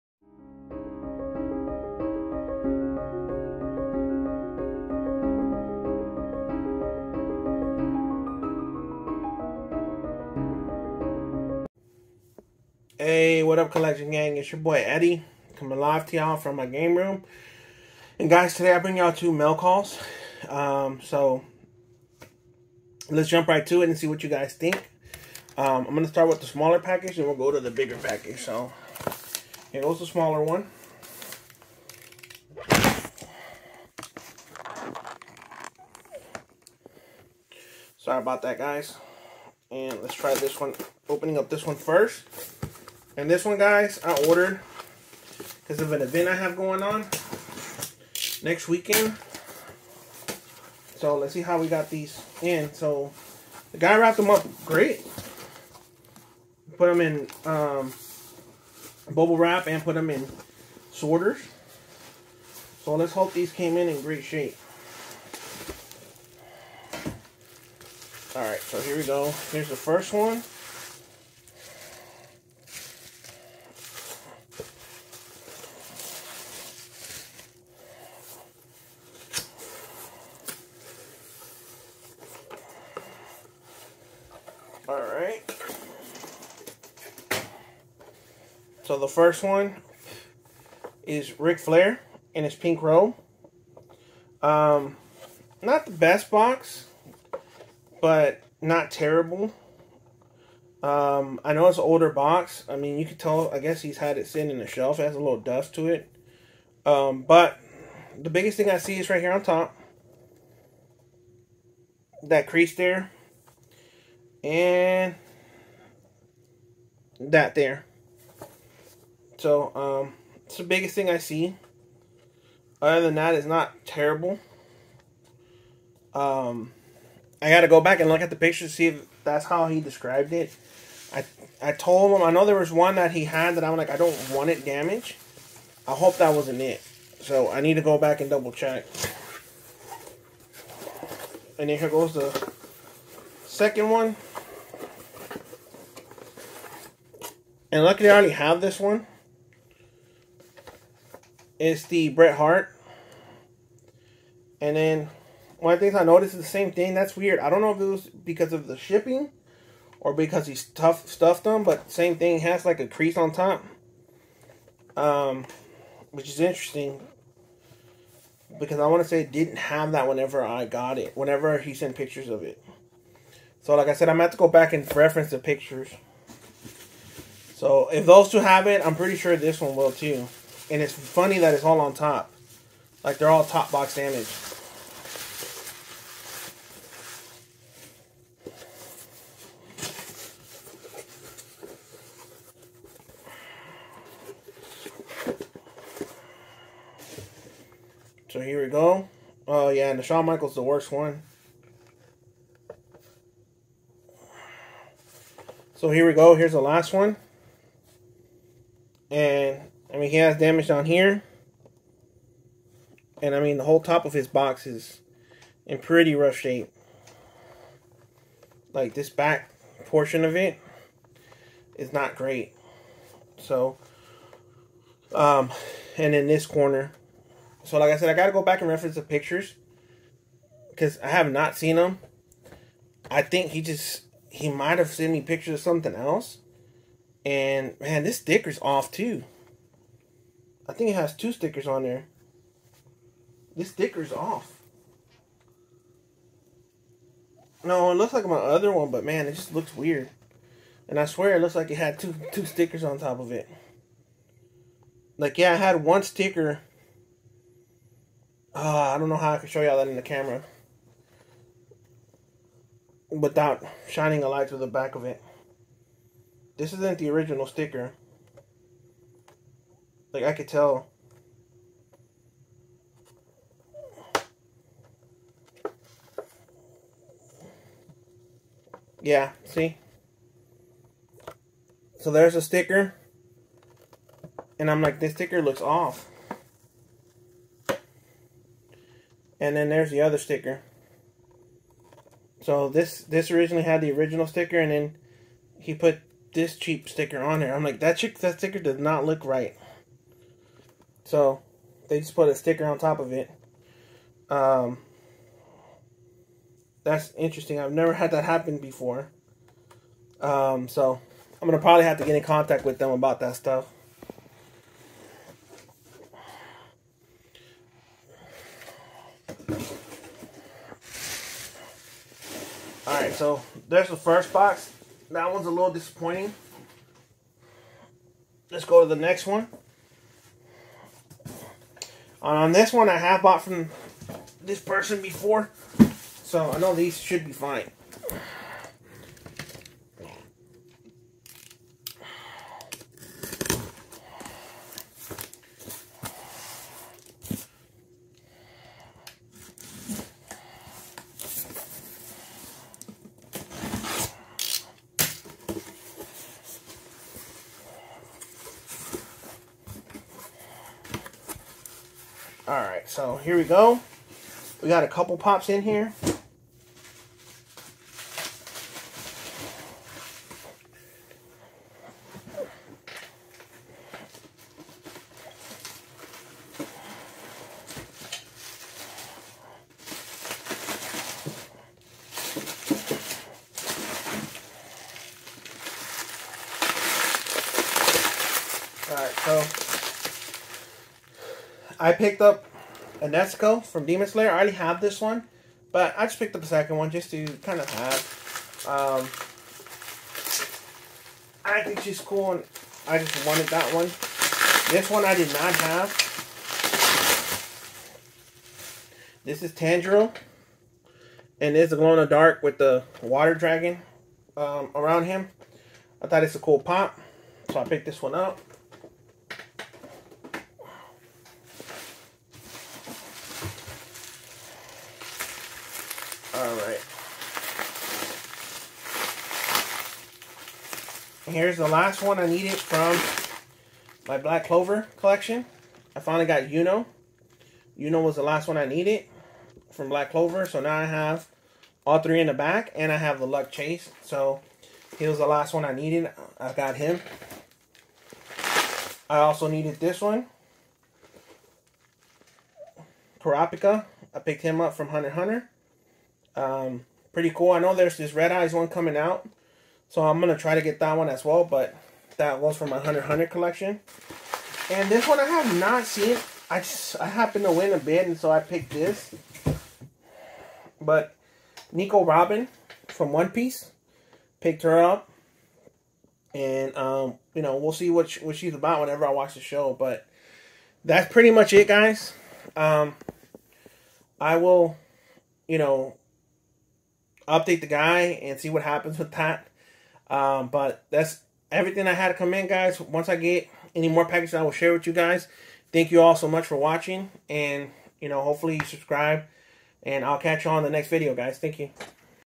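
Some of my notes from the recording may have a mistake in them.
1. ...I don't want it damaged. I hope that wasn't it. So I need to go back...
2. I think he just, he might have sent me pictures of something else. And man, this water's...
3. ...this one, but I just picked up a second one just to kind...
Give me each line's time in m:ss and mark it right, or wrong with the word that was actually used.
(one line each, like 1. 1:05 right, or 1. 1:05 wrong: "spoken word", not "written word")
1. 2:13 right
2. 3:53 wrong: "sticker", not "water"
3. 6:34 right.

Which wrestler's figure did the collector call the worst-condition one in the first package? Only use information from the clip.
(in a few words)
Shawn Michaels.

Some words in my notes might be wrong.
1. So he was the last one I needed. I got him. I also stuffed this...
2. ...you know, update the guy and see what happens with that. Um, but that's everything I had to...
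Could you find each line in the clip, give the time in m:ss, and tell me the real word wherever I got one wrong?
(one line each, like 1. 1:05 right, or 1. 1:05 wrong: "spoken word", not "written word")
1. 7:24 wrong: "needed", not "stuffed"
2. 8:05 right.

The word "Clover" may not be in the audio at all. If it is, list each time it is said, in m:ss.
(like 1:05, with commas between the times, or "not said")
7:14, 7:20.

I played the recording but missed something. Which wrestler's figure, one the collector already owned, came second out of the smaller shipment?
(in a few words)
Bret Hart.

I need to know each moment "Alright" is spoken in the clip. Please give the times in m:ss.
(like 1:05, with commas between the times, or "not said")
1:08, 5:22, 6:02.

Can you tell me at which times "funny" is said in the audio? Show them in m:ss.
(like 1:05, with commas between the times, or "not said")
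3:00.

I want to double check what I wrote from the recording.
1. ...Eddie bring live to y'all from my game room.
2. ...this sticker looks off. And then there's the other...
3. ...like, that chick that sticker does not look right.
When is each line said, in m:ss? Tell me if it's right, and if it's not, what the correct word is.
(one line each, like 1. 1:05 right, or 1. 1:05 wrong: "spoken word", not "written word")
1. 0:14 wrong: "coming", not "bring"
2. 4:44 right
3. 4:57 right.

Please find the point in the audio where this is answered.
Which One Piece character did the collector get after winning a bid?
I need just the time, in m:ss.
7:51.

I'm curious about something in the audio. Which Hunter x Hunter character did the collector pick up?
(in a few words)
Kurapika.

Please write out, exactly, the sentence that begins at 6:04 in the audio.
We got a couple pops in here.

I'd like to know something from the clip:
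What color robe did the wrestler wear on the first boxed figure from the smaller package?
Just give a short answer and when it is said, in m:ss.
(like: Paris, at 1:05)
Pink, at 1:32.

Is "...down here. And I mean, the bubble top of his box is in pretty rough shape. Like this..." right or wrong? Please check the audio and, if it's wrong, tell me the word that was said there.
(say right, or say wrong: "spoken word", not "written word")
wrong: "whole", not "bubble".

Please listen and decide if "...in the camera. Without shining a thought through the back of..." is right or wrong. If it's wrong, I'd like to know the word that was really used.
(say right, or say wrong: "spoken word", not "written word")
wrong: "light", not "thought".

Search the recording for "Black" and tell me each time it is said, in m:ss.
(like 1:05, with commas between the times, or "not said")
7:14, 7:19.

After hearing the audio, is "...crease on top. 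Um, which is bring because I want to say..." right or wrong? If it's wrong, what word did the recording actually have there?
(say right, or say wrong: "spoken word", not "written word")
wrong: "interesting", not "bring".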